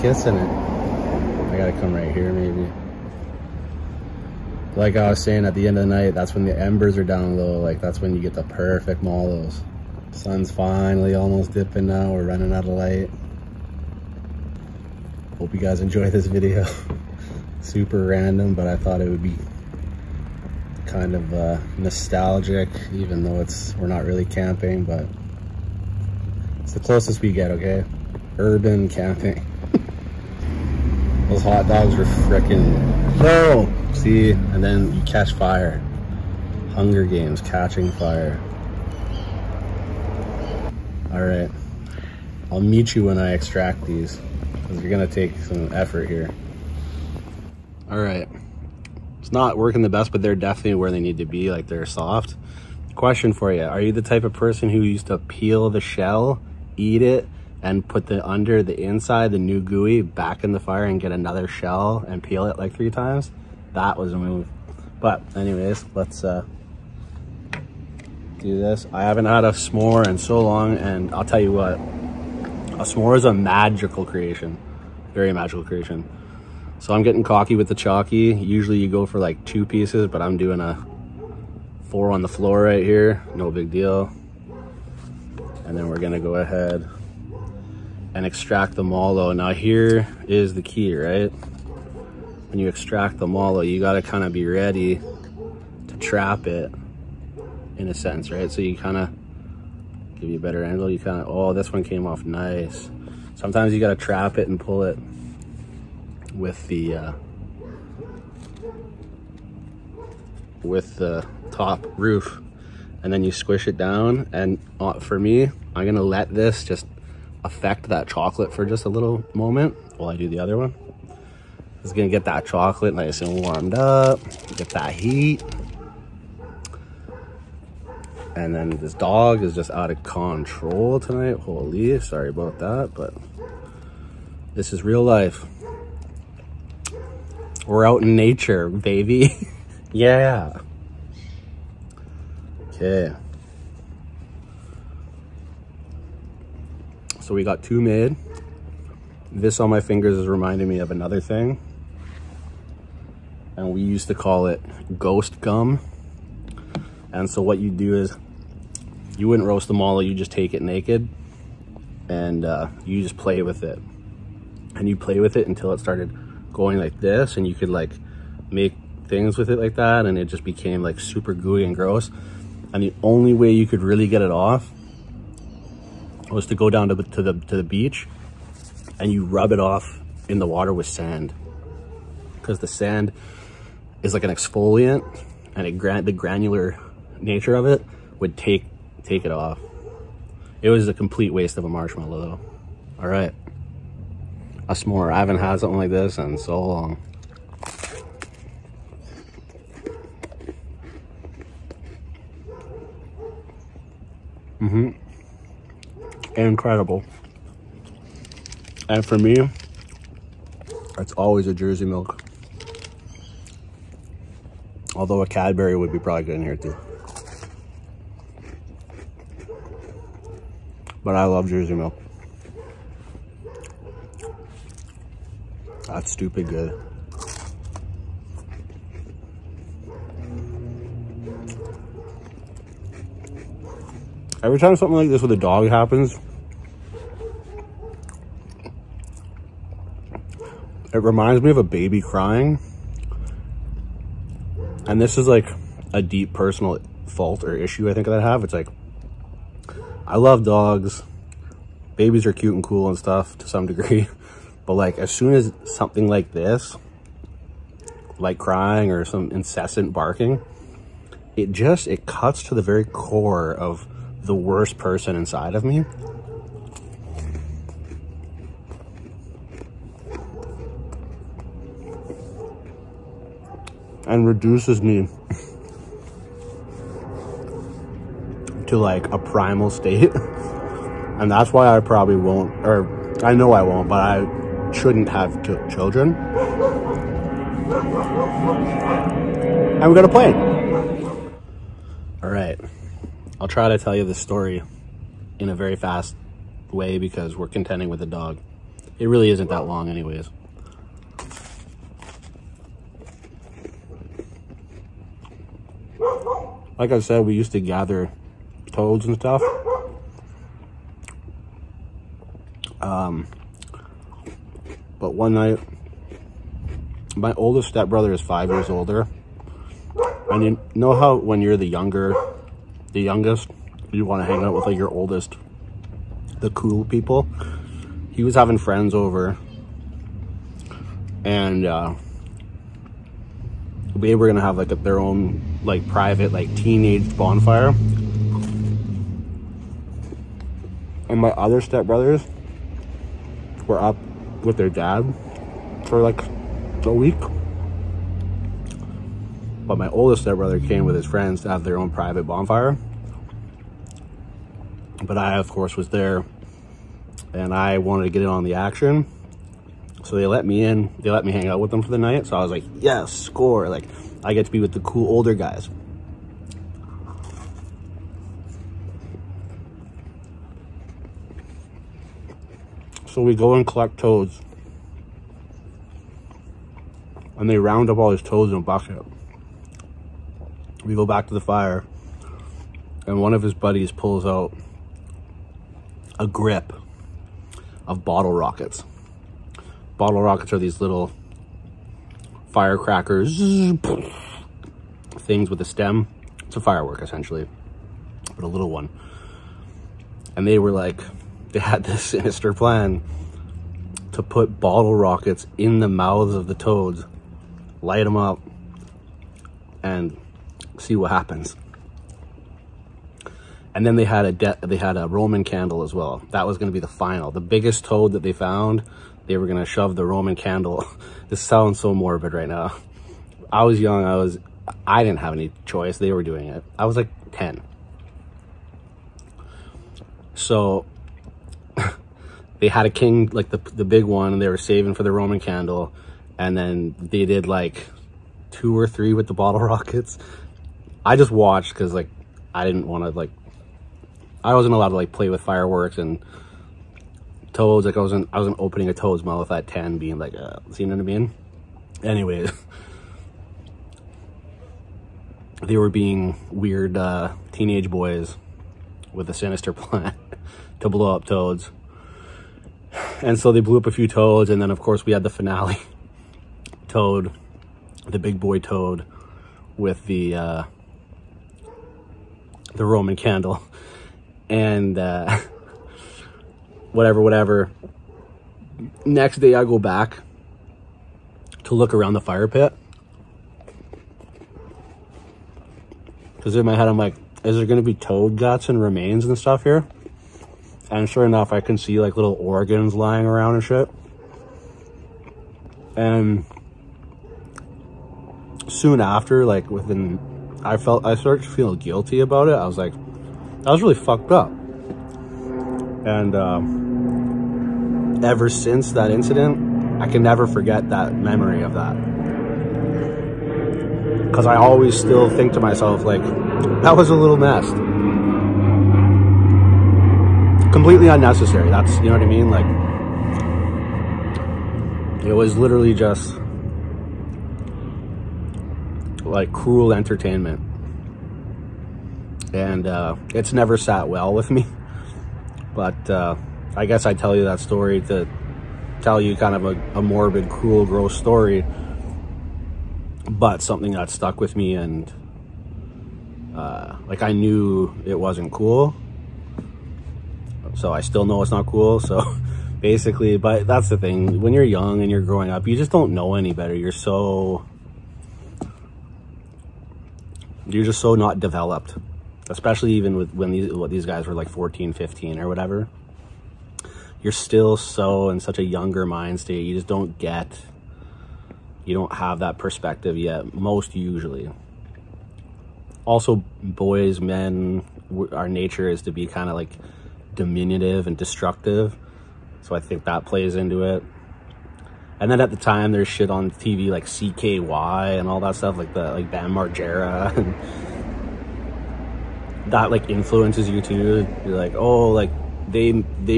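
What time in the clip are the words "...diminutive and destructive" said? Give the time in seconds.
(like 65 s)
580 s.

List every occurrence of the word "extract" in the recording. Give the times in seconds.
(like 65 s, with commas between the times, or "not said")
43 s, 88 s, 92 s.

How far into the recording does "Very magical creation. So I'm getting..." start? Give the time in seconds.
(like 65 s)
75 s.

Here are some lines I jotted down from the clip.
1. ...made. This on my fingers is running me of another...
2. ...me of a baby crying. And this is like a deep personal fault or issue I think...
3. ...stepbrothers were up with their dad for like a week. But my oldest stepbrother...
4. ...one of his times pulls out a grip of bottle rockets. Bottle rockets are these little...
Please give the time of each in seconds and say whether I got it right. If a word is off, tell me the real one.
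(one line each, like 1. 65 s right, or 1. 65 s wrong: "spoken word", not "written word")
1. 147 s wrong: "reminding", not "running"
2. 241 s right
3. 341 s right
4. 383 s wrong: "buddies", not "times".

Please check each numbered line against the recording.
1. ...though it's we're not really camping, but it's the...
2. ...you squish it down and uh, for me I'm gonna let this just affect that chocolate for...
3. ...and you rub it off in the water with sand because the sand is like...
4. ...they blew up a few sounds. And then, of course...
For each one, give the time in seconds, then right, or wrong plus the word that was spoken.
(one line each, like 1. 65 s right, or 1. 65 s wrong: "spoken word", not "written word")
1. 23 s right
2. 113 s right
3. 178 s right
4. 463 s wrong: "toads", not "sounds".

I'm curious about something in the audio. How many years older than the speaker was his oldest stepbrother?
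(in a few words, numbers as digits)
5.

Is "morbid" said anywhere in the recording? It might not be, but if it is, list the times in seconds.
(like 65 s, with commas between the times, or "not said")
421 s, 540 s.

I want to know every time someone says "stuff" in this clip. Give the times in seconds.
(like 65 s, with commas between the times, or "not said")
252 s, 309 s, 489 s, 588 s.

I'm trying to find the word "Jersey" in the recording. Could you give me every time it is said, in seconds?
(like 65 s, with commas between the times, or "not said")
211 s, 221 s.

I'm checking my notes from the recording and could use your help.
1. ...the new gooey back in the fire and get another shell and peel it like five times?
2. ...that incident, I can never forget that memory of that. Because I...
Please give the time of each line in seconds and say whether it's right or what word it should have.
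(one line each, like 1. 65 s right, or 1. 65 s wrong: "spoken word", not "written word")
1. 59 s wrong: "three", not "five"
2. 508 s right.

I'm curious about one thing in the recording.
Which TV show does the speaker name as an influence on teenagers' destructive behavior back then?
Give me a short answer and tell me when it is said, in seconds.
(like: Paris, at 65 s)
CKY, at 587 s.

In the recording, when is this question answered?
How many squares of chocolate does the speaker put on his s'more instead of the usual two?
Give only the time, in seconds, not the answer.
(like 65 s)
81 s.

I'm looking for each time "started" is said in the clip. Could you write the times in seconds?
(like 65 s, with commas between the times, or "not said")
165 s, 501 s.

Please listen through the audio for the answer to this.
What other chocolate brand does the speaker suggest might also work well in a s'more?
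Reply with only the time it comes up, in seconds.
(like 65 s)
215 s.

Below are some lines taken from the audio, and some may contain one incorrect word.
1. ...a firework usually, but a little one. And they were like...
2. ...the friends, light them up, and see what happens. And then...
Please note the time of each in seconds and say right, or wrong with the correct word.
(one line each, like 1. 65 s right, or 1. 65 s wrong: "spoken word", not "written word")
1. 396 s wrong: "essentially", not "usually"
2. 406 s wrong: "toads", not "friends".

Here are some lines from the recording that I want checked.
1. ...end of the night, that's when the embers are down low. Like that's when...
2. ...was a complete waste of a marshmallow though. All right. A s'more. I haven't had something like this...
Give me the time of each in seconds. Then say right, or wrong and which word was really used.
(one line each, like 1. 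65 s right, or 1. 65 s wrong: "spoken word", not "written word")
1. 5 s right
2. 190 s right.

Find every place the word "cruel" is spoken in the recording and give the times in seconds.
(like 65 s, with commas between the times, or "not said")
529 s, 540 s.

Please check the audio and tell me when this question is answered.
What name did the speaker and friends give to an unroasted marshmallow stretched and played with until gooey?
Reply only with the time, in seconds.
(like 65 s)
154 s.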